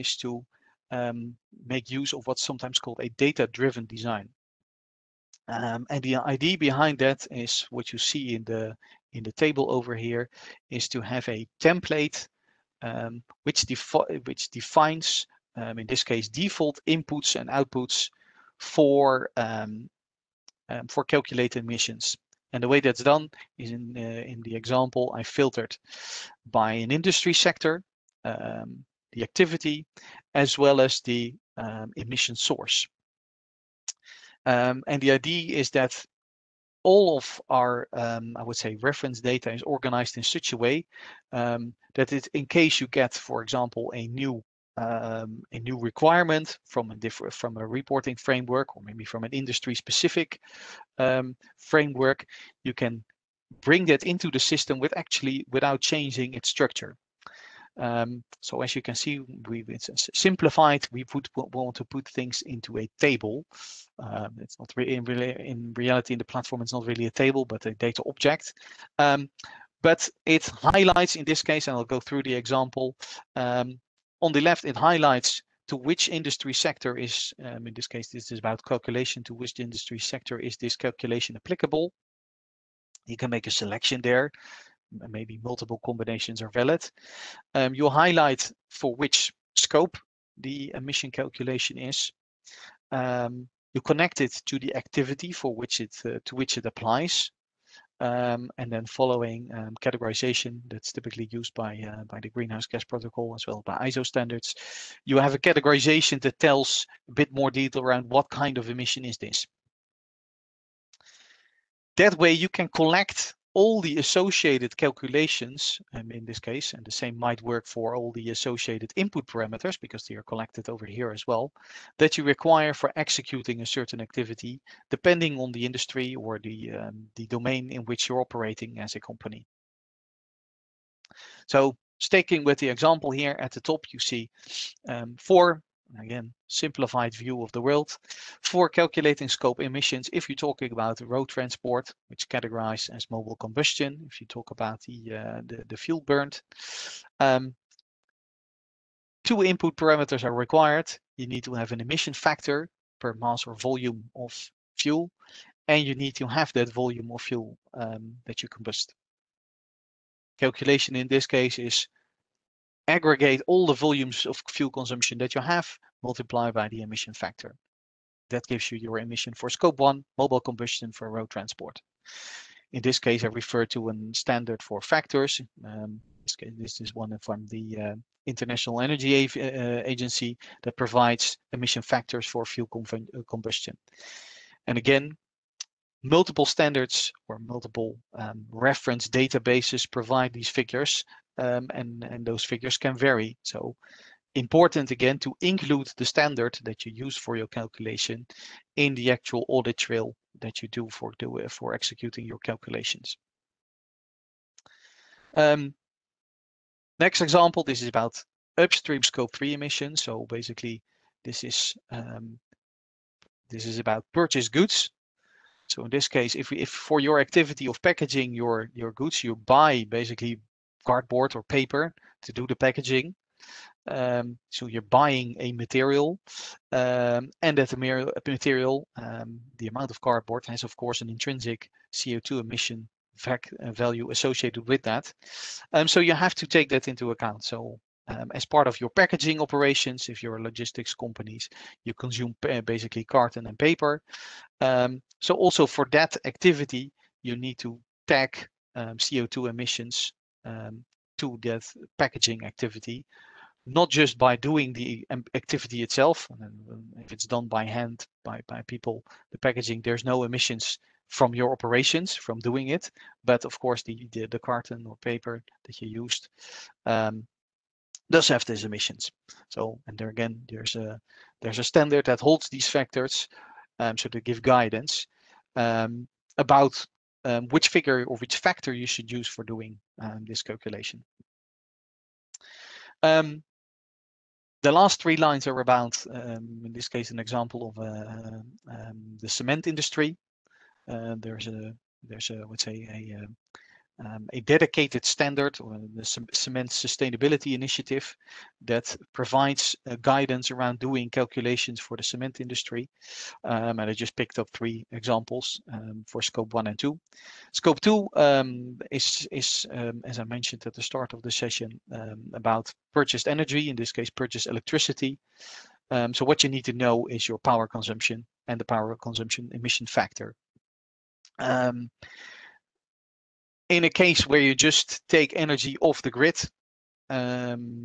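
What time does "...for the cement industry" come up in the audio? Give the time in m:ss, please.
5:01.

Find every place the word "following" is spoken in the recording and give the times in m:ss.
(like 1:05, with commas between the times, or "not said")
1:38.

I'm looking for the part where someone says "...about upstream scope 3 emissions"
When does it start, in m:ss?
3:27.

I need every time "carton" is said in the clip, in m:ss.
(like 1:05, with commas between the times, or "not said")
4:03, 4:24.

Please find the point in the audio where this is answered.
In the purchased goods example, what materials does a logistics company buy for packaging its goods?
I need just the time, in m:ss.
3:40.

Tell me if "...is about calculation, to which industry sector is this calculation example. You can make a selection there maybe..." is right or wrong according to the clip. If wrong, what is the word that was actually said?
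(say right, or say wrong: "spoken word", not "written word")
wrong: "applicable", not "example".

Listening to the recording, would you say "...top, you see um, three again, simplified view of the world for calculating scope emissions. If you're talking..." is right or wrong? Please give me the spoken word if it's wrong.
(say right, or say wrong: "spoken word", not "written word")
wrong: "four", not "three".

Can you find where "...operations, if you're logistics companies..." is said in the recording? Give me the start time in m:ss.
3:59.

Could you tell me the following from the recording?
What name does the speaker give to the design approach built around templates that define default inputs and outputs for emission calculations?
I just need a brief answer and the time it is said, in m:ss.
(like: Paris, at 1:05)
Data-driven design, at 0:03.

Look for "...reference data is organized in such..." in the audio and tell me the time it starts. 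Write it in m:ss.
0:38.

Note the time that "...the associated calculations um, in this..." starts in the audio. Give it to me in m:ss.
1:53.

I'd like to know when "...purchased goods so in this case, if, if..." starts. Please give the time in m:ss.
3:34.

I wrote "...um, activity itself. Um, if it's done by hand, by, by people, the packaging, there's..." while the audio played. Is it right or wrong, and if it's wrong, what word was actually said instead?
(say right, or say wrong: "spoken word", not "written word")
right.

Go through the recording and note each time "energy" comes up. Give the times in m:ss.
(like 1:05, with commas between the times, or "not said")
2:58, 5:13, 5:25.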